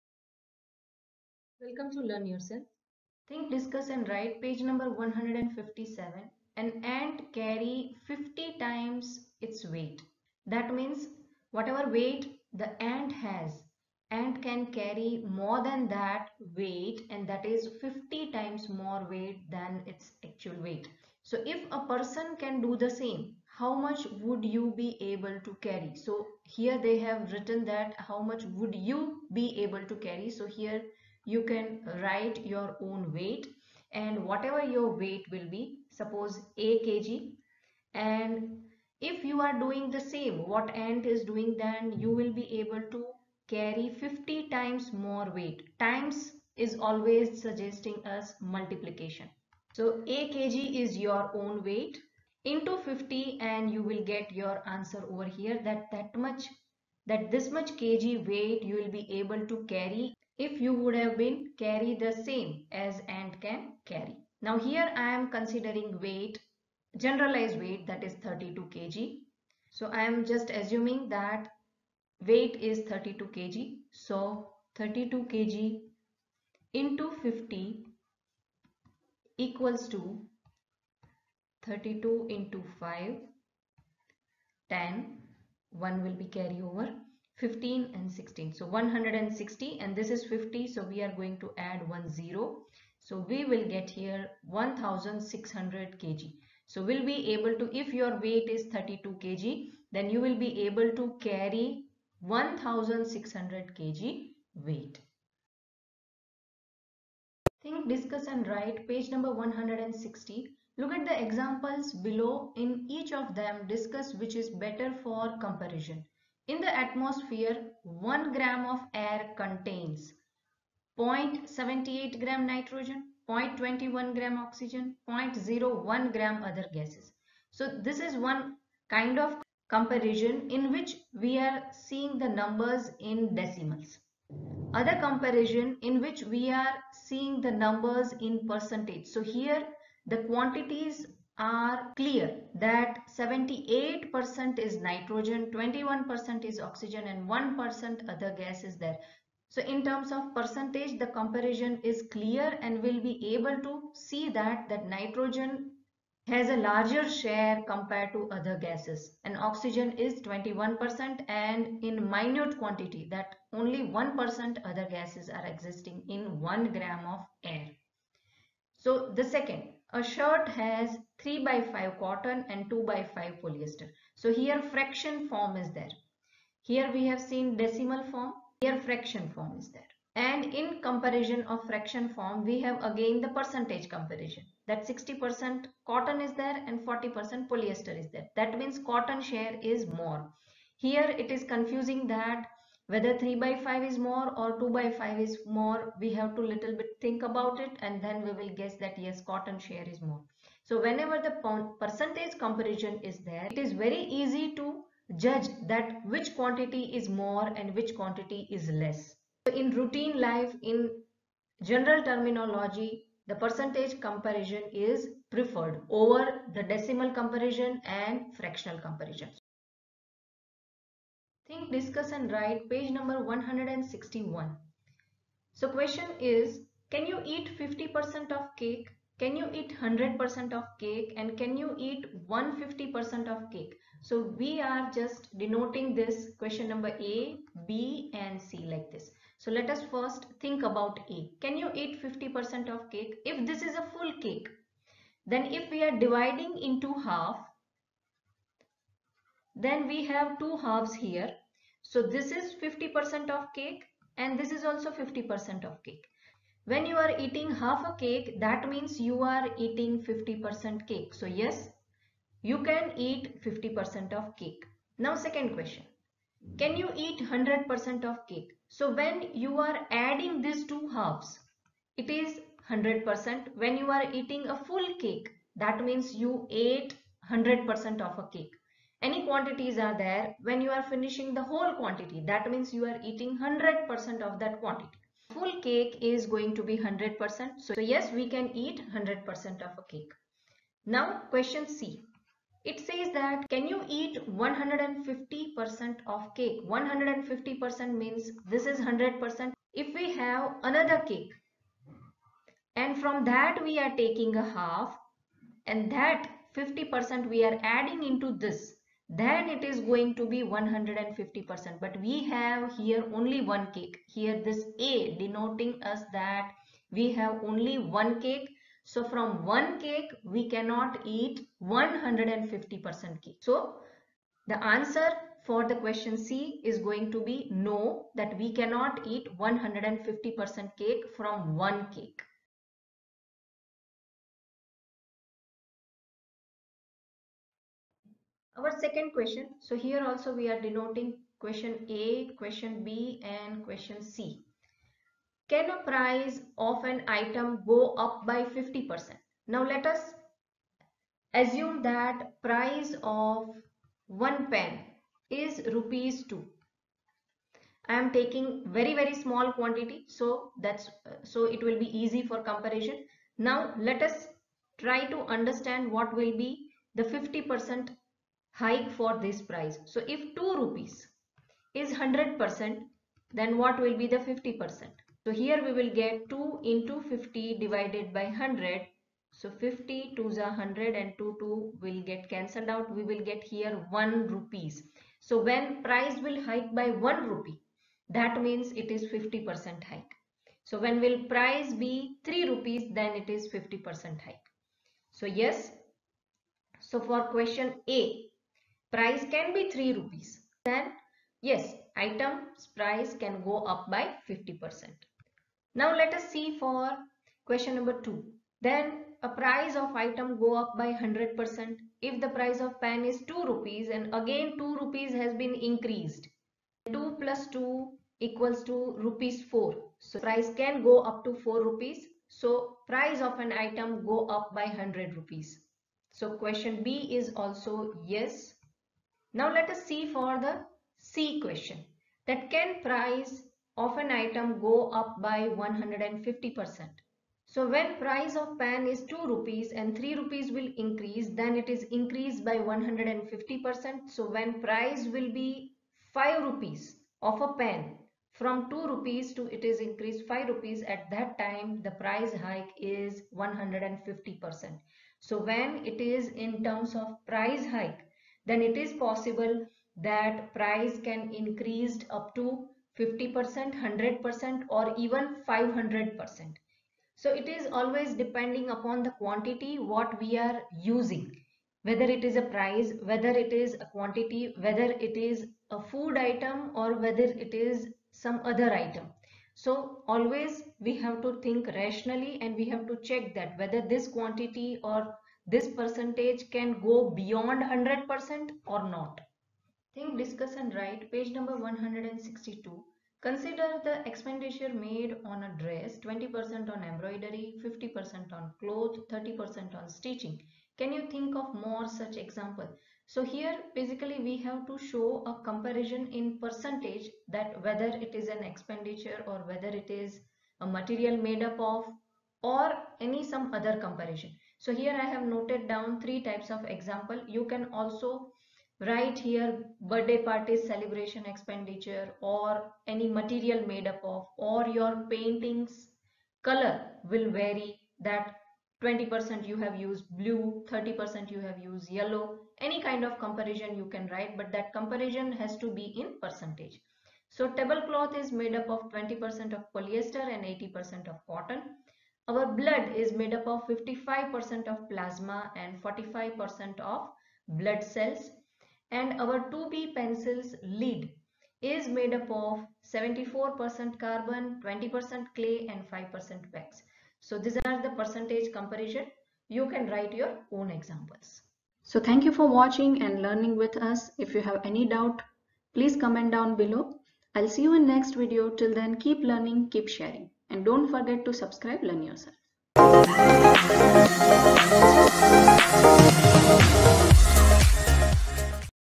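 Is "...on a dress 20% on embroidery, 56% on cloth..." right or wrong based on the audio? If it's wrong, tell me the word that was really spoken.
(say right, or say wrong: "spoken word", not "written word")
wrong: "50", not "56".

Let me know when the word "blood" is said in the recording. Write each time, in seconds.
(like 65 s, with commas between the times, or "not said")
542 s, 547 s.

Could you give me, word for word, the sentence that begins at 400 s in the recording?
Then yes, item's price can go up by 50%.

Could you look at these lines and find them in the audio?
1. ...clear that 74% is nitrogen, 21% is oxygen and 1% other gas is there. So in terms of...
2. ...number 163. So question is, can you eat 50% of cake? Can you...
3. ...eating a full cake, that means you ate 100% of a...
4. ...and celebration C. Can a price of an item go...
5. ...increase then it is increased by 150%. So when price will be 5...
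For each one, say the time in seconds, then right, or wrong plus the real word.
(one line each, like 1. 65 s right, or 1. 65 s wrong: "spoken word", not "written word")
1. 141 s wrong: "78", not "74"
2. 222 s wrong: "161", not "163"
3. 274 s right
4. 343 s wrong: "question", not "celebration"
5. 440 s right.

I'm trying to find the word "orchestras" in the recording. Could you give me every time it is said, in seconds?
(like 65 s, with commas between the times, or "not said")
not said.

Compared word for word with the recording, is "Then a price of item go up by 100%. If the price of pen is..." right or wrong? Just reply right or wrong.
right.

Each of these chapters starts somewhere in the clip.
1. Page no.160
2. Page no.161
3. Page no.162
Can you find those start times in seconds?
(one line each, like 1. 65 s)
1. 112 s
2. 221 s
3. 490 s.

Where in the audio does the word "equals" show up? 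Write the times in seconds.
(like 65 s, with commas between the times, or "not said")
79 s, 418 s.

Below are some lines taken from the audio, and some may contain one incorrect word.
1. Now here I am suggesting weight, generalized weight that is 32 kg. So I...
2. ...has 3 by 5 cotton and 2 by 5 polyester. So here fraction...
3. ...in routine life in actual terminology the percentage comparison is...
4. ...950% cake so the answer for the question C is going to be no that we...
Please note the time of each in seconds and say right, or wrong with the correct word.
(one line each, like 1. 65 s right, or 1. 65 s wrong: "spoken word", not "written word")
1. 64 s wrong: "considering", not "suggesting"
2. 170 s right
3. 209 s wrong: "general", not "actual"
4. 321 s wrong: "150", not "950".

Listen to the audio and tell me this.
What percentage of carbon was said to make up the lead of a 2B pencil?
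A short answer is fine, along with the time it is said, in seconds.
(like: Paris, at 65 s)
74%, at 552 s.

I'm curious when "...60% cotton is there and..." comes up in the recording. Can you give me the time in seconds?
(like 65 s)
184 s.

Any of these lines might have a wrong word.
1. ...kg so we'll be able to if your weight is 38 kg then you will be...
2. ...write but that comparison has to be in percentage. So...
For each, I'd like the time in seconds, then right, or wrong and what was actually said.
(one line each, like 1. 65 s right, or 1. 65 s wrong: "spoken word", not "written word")
1. 96 s wrong: "32", not "38"
2. 534 s right.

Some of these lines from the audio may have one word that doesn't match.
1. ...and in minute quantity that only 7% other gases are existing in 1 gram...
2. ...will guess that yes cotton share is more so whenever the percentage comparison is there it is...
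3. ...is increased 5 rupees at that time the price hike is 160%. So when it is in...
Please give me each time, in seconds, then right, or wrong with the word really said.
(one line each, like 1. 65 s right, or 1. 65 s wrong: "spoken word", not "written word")
1. 161 s wrong: "1", not "7"
2. 198 s right
3. 449 s wrong: "150", not "160".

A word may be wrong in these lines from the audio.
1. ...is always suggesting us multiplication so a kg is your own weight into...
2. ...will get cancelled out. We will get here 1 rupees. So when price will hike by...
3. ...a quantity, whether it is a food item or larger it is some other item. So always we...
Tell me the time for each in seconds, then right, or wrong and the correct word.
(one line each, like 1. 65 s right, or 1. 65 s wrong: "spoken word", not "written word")
1. 46 s right
2. 381 s right
3. 473 s wrong: "whether", not "larger".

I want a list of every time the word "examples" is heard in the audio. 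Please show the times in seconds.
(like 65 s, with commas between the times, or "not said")
111 s, 502 s, 516 s, 560 s.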